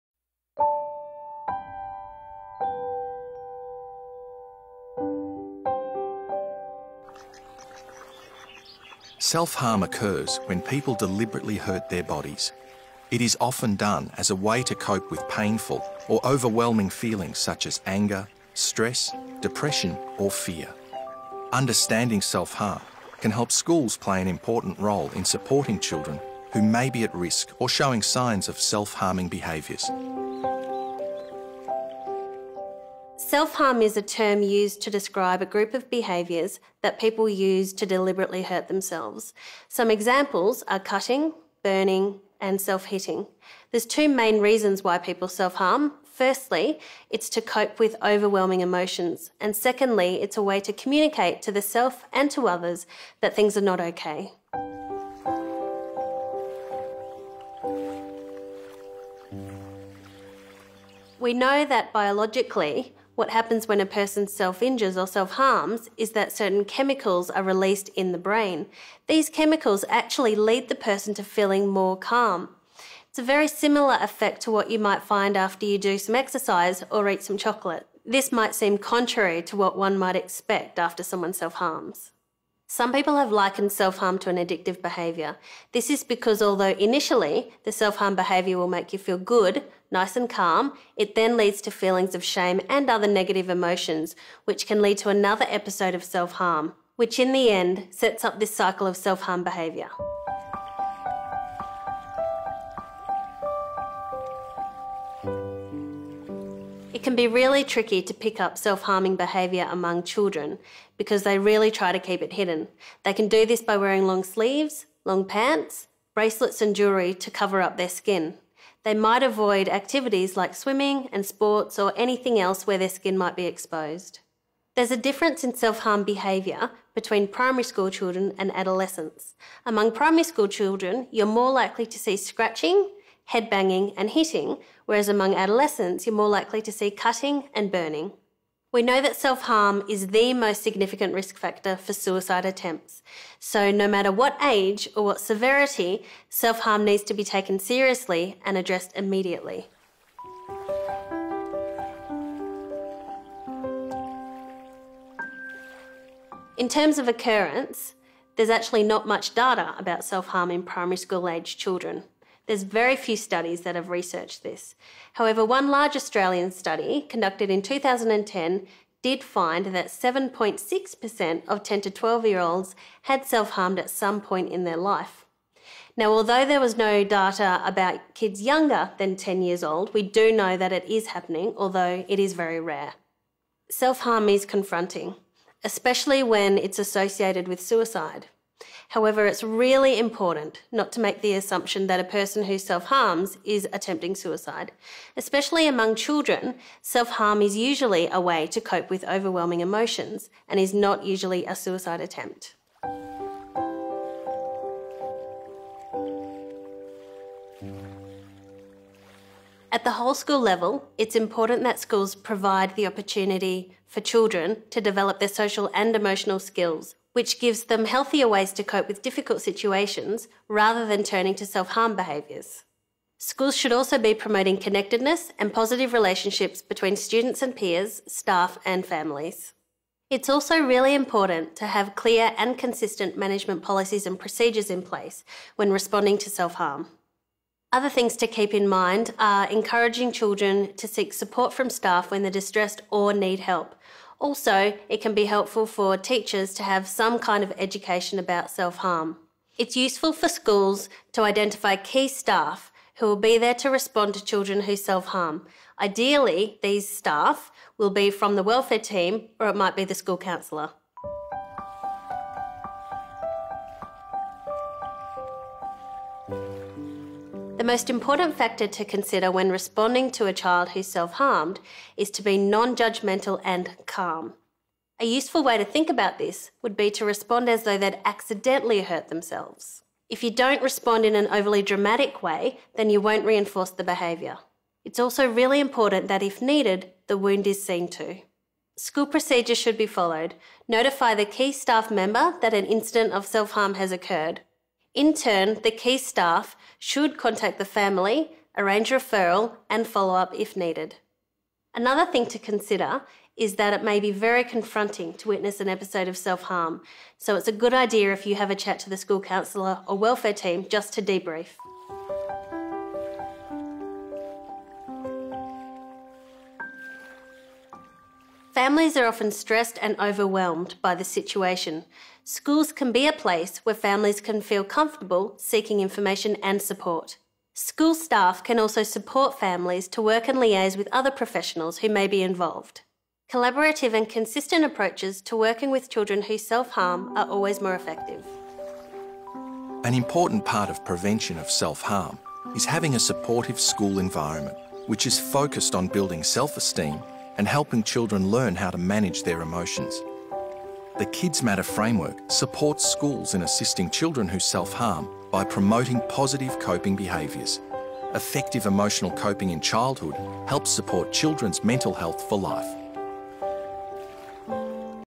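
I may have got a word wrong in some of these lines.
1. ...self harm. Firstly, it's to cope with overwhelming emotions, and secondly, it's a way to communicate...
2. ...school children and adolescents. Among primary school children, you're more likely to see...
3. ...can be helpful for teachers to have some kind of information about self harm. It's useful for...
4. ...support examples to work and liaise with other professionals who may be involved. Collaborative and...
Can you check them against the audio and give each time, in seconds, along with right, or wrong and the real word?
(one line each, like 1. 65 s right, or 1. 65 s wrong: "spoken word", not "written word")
1. 45 s right
2. 127 s right
3. 245 s wrong: "education", not "information"
4. 328 s wrong: "families", not "examples".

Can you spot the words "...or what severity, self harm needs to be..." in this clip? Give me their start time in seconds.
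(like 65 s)
144 s.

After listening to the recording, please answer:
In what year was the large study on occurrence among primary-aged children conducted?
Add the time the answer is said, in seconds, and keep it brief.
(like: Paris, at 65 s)
2010, at 167 s.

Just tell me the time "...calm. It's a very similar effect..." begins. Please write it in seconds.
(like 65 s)
71 s.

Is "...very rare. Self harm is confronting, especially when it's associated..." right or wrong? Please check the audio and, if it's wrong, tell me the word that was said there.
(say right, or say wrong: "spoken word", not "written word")
right.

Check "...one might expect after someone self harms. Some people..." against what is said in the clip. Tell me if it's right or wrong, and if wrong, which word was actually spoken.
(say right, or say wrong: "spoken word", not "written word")
right.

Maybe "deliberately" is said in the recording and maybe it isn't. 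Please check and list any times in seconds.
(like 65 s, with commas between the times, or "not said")
10 s, 37 s.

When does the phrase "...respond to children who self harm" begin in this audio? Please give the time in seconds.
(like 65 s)
253 s.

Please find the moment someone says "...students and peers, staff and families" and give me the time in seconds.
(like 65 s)
226 s.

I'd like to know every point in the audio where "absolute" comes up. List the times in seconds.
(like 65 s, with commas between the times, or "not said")
not said.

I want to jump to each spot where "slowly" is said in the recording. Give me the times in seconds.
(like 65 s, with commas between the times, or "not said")
not said.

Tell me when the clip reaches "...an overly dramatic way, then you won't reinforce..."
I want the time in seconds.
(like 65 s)
281 s.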